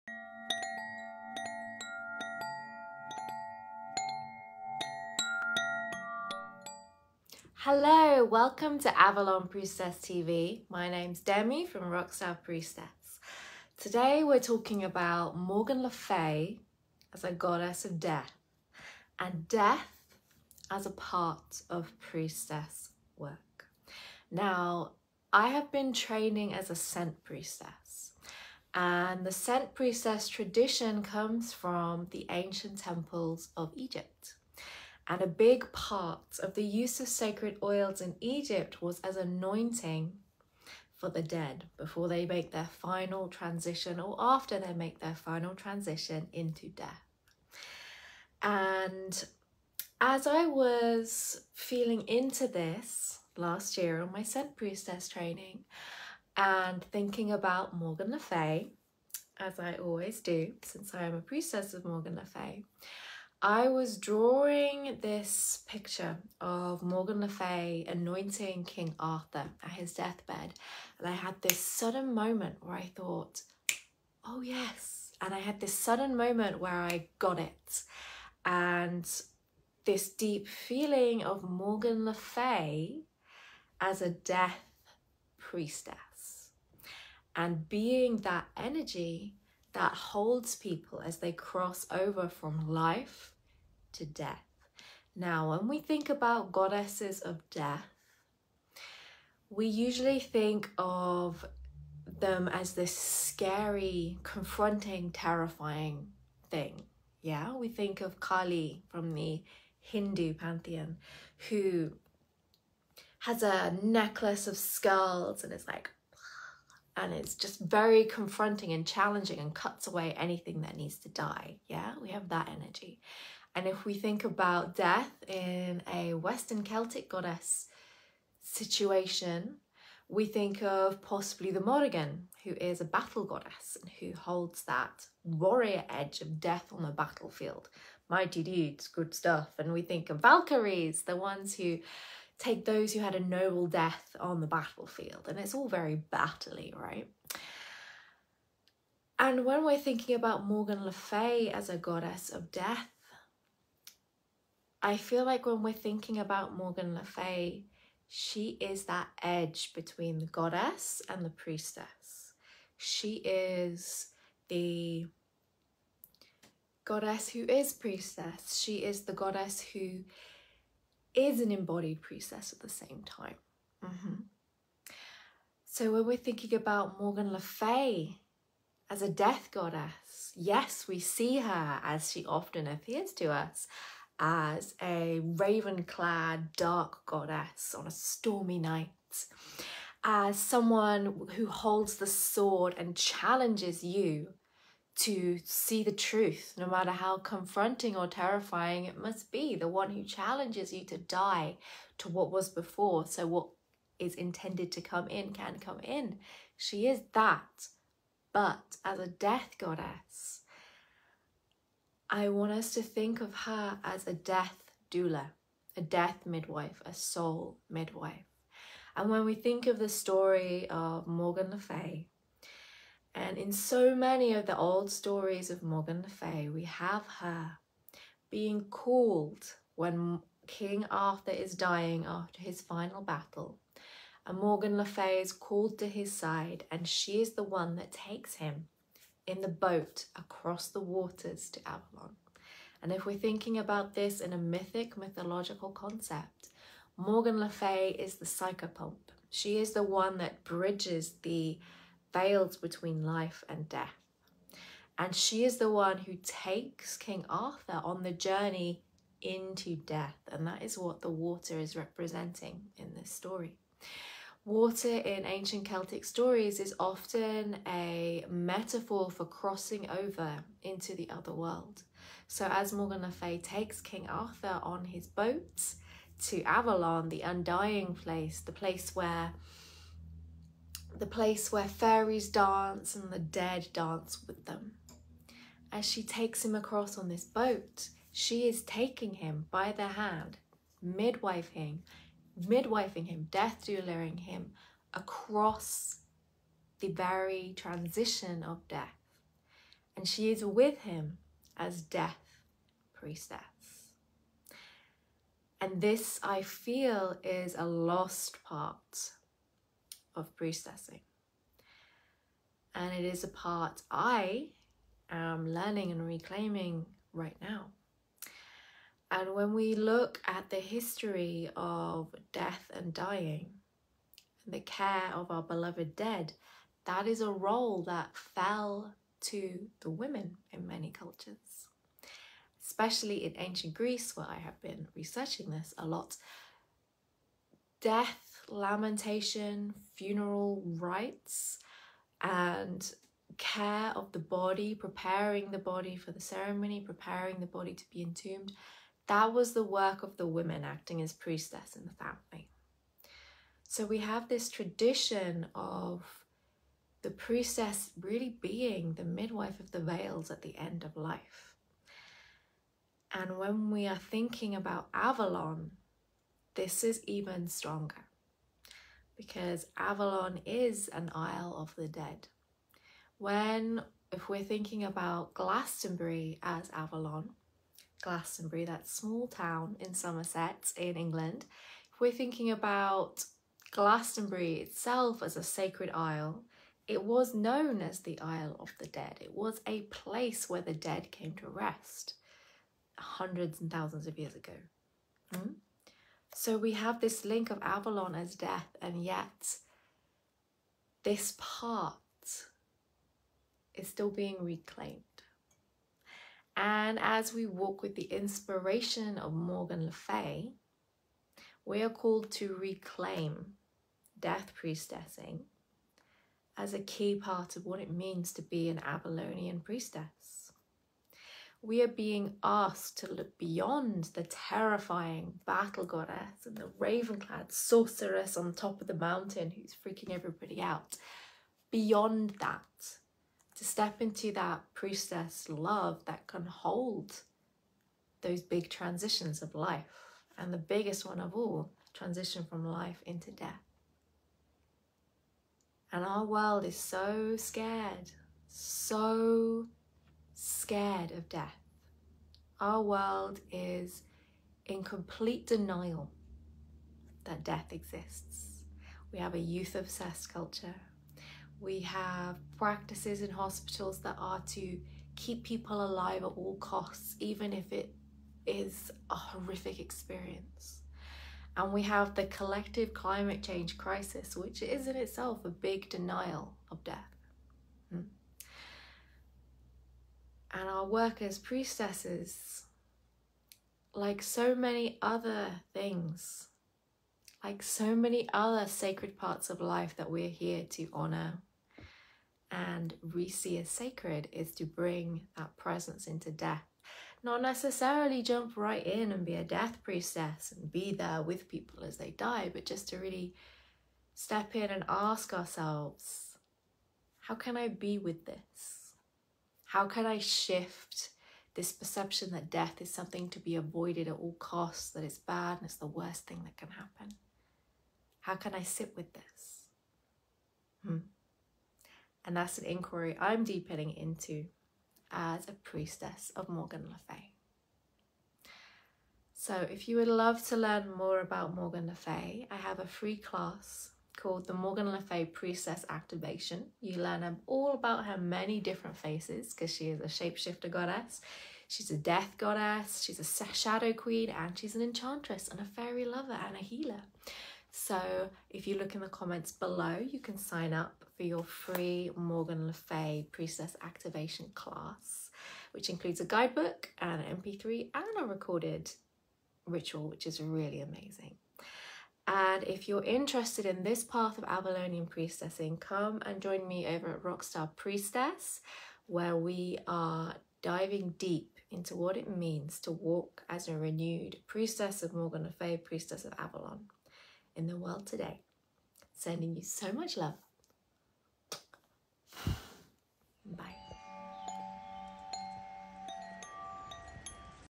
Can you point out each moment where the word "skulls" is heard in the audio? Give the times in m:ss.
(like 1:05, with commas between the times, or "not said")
1:54.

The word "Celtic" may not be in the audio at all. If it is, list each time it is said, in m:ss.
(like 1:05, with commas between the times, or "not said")
2:06, 4:25.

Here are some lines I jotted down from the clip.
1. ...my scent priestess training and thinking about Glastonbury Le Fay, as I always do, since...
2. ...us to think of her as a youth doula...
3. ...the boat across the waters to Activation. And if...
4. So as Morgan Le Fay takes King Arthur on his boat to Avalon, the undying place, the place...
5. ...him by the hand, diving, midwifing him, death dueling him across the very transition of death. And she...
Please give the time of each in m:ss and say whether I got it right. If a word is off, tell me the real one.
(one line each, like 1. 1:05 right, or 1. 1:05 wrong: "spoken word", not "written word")
1. 0:54 wrong: "Morgan", not "Glastonbury"
2. 3:32 wrong: "death", not "youth"
3. 3:59 wrong: "Avalon", not "Activation"
4. 4:32 right
5. 4:49 wrong: "midwifing", not "diving".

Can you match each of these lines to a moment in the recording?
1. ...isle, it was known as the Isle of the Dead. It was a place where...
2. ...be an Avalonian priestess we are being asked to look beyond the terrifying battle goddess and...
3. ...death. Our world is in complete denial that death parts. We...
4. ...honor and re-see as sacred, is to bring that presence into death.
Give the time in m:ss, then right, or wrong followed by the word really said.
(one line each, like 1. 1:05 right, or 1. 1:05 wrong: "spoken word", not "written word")
1. 6:25 right
2. 6:58 right
3. 7:31 wrong: "exists", not "parts"
4. 8:10 right.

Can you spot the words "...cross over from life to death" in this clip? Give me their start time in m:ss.
1:31.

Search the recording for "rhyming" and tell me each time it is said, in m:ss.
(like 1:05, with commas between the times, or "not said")
not said.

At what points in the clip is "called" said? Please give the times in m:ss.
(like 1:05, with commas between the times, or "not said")
3:48, 3:55, 6:51, 8:54.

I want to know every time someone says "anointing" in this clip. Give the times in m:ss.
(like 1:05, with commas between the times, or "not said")
0:39, 1:07.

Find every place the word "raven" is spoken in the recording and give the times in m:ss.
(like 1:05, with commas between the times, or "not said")
3:05, 7:06.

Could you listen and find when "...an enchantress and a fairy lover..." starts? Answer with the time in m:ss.
9:04.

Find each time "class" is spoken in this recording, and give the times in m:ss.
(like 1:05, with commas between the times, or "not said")
8:53, 9:14.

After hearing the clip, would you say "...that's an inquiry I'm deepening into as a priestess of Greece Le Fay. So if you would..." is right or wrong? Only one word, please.
wrong.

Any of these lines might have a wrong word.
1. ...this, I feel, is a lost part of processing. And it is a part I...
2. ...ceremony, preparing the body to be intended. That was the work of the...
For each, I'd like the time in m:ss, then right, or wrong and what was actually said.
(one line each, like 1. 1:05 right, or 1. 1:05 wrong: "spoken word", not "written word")
1. 5:05 right
2. 5:46 wrong: "entombed", not "intended".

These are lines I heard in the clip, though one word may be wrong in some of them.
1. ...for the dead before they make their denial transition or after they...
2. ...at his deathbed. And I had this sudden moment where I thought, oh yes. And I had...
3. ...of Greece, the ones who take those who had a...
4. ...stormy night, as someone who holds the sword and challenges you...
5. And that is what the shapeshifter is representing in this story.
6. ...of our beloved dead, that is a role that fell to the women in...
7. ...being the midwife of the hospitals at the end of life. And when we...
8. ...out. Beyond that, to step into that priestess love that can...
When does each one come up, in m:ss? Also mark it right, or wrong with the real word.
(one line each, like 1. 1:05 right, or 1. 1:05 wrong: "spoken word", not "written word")
1. 0:40 wrong: "final", not "denial"
2. 1:09 right
3. 2:20 wrong: "Valkyries", not "Greece"
4. 3:07 right
5. 4:20 wrong: "water", not "shapeshifter"
6. 5:25 right
7. 5:58 wrong: "veils", not "hospitals"
8. 7:10 right.